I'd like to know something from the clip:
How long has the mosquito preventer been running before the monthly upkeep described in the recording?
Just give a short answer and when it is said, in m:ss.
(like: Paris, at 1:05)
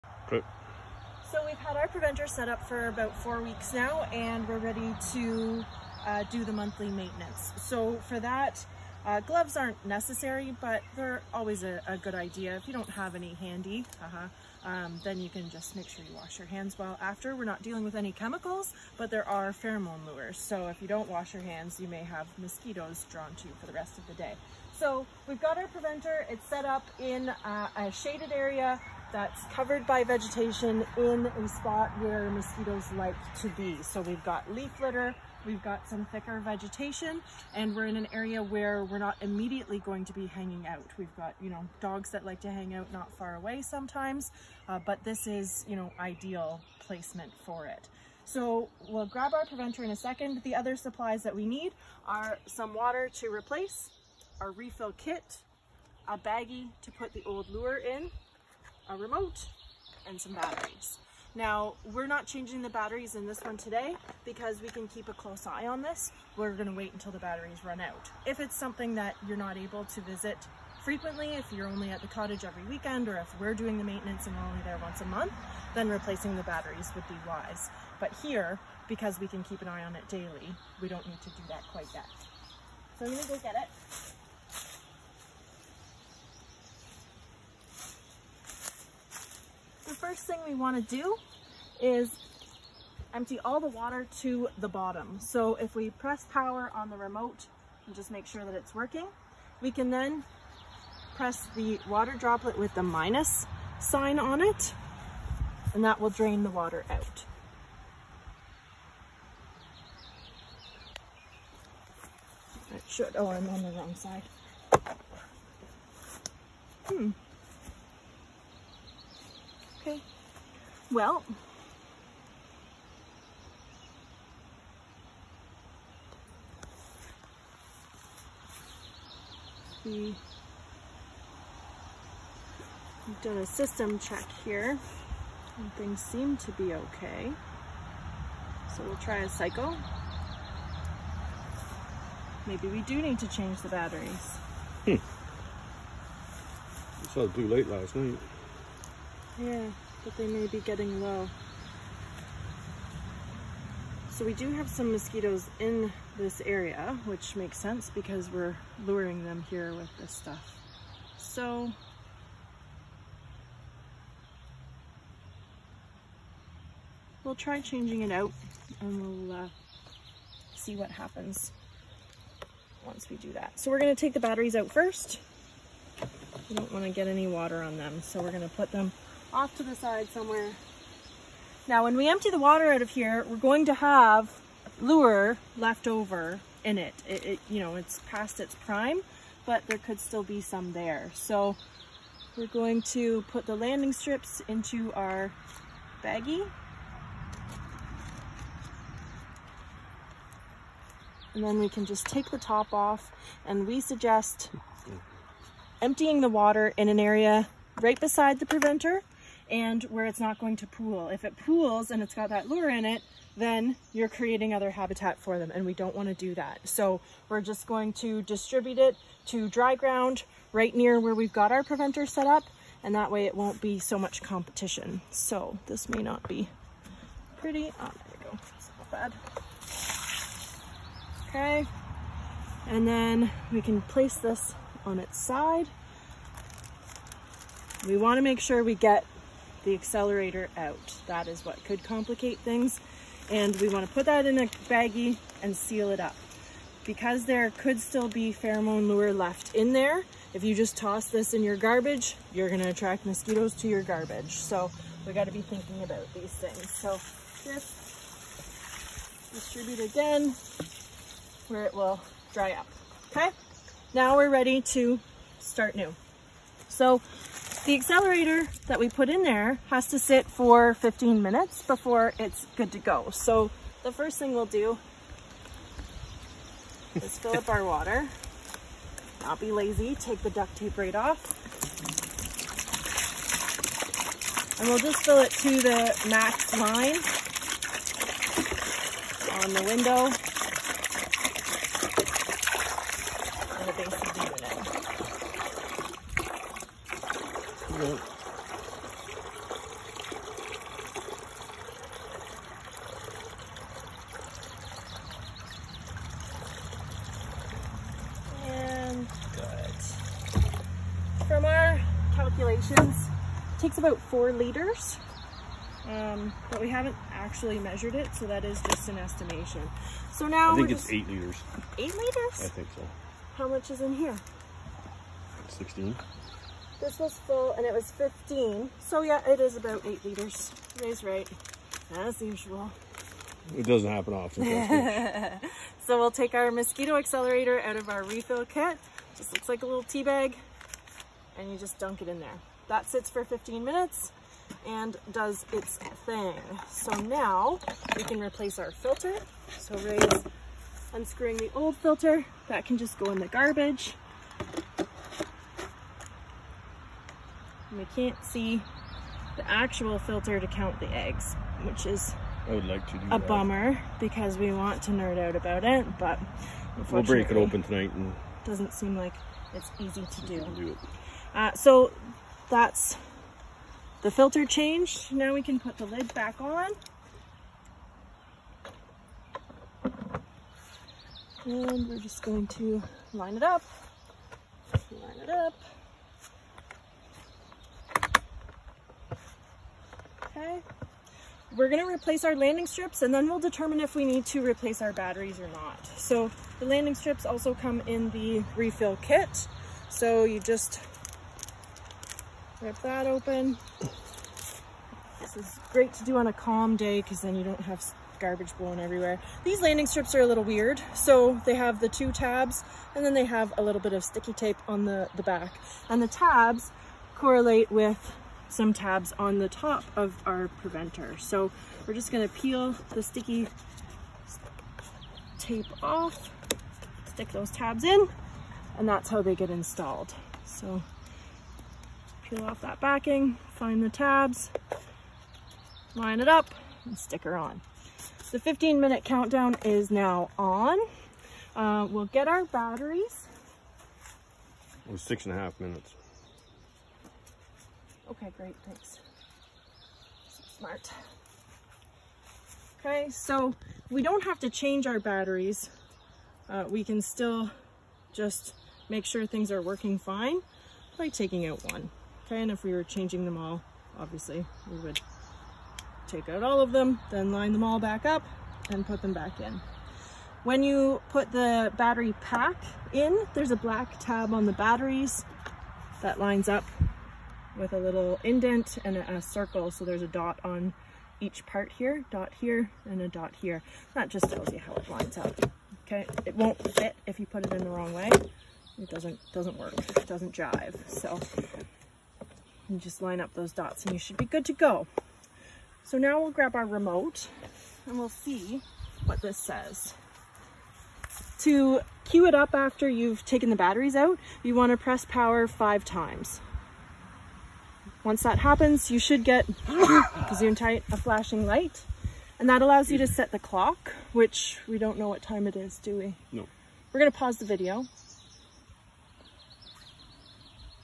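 4 weeks, at 0:03.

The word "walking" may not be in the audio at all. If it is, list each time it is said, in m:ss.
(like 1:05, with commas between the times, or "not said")
not said.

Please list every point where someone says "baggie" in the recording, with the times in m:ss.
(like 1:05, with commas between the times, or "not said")
0:56, 3:16, 4:04.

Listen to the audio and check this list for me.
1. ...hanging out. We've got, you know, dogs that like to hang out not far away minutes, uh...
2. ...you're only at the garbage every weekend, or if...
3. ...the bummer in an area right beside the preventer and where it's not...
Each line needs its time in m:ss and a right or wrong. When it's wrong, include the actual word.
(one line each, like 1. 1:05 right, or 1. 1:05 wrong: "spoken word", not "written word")
1. 0:40 wrong: "sometimes", not "minutes"
2. 1:11 wrong: "cottage", not "garbage"
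3. 3:26 wrong: "water", not "bummer".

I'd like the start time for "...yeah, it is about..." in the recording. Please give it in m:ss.
5:29.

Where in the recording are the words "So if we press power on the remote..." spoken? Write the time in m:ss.
1:35.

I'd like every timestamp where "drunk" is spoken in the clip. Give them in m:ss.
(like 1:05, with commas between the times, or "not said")
not said.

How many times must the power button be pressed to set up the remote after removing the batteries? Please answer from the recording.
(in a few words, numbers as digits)
5.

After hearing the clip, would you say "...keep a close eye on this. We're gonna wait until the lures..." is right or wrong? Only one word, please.
wrong.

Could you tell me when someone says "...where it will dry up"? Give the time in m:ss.
4:21.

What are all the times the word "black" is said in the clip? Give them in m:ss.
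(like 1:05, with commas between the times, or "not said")
7:53.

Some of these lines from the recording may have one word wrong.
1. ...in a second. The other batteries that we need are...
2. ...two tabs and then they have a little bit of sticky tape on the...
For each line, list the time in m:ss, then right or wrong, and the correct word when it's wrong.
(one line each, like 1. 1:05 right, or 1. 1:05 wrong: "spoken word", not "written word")
1. 0:49 wrong: "supplies", not "batteries"
2. 6:51 right.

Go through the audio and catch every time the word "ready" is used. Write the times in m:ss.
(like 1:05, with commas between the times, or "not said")
0:04, 4:24.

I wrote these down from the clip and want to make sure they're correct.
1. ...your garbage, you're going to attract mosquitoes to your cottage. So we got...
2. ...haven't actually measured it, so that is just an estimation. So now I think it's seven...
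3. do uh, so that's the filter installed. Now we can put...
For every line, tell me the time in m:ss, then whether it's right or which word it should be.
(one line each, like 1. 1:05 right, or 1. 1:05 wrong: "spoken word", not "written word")
1. 4:11 wrong: "garbage", not "cottage"
2. 5:16 wrong: "eight", not "seven"
3. 6:10 wrong: "changed", not "installed".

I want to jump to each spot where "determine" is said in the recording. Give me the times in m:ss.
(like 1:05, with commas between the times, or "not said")
6:33.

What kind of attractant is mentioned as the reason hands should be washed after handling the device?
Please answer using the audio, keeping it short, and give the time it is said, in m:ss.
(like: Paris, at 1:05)
pheromone lures, at 0:19.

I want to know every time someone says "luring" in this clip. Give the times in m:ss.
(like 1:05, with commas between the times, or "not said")
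2:38.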